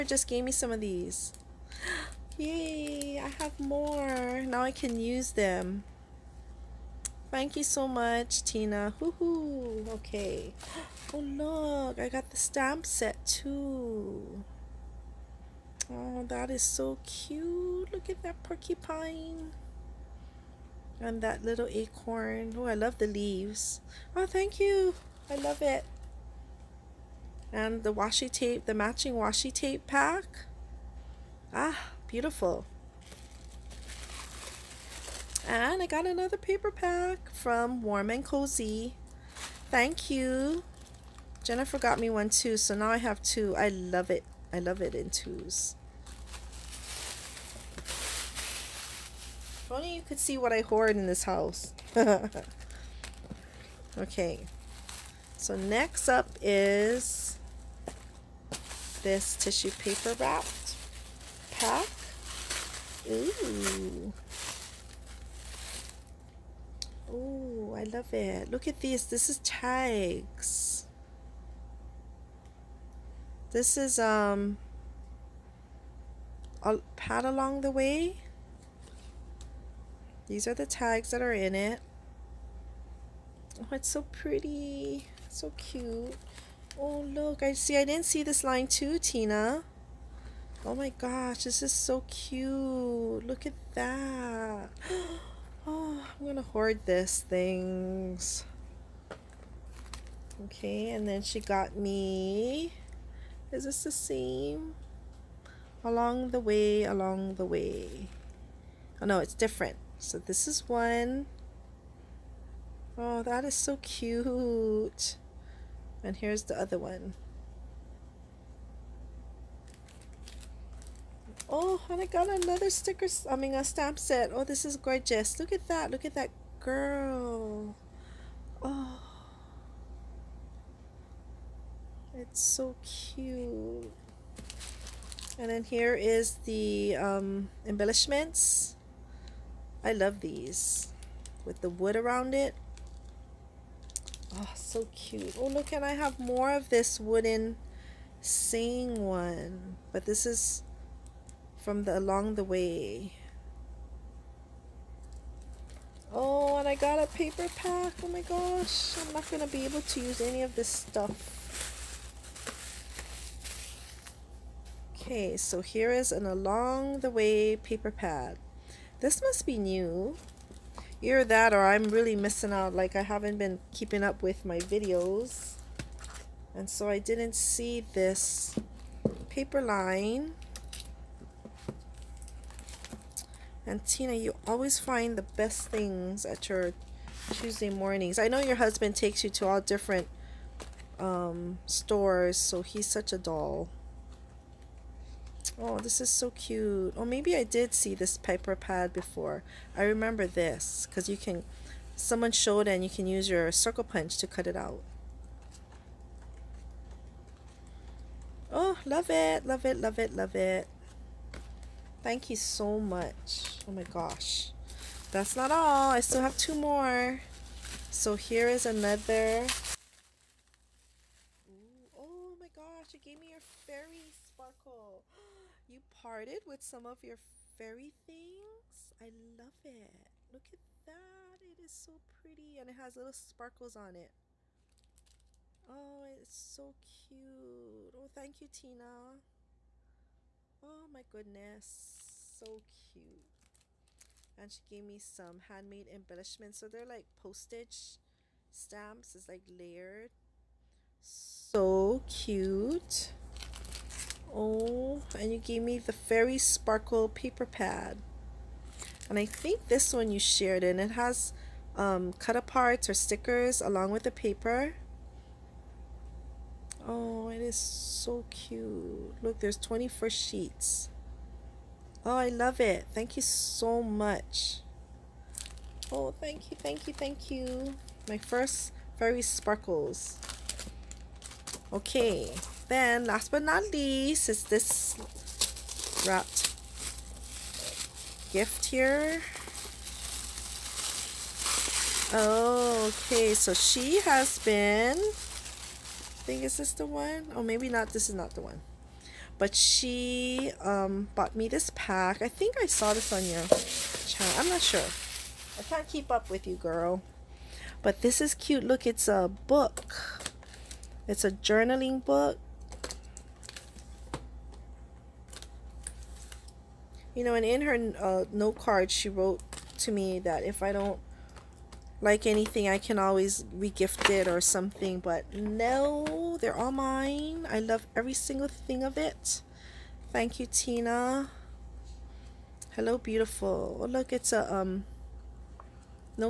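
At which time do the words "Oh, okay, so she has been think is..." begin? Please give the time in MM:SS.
04:52.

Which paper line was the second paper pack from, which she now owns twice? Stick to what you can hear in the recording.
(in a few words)
Warm and Cozy.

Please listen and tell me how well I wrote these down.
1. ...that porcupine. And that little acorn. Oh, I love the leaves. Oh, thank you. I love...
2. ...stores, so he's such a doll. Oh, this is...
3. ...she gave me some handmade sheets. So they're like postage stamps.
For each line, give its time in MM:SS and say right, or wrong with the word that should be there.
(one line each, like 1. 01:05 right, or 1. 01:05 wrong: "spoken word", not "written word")
1. 00:18 right
2. 03:11 right
3. 04:04 wrong: "embellishments", not "sheets".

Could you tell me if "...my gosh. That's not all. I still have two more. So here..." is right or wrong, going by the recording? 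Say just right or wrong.
right.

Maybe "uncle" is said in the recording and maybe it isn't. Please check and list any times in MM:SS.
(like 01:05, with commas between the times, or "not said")
not said.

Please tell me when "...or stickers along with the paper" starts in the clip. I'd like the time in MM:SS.
04:22.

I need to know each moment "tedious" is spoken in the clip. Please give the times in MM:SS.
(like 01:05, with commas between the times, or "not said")
not said.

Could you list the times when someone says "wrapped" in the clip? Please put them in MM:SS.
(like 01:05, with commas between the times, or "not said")
01:00, 04:46.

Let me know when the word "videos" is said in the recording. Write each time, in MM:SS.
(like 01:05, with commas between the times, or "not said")
02:54.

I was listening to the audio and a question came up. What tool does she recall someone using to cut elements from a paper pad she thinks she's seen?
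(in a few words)
circle punch.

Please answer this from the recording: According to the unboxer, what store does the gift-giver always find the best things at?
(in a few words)
Tuesday mornings.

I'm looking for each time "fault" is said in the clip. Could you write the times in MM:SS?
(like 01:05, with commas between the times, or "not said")
not said.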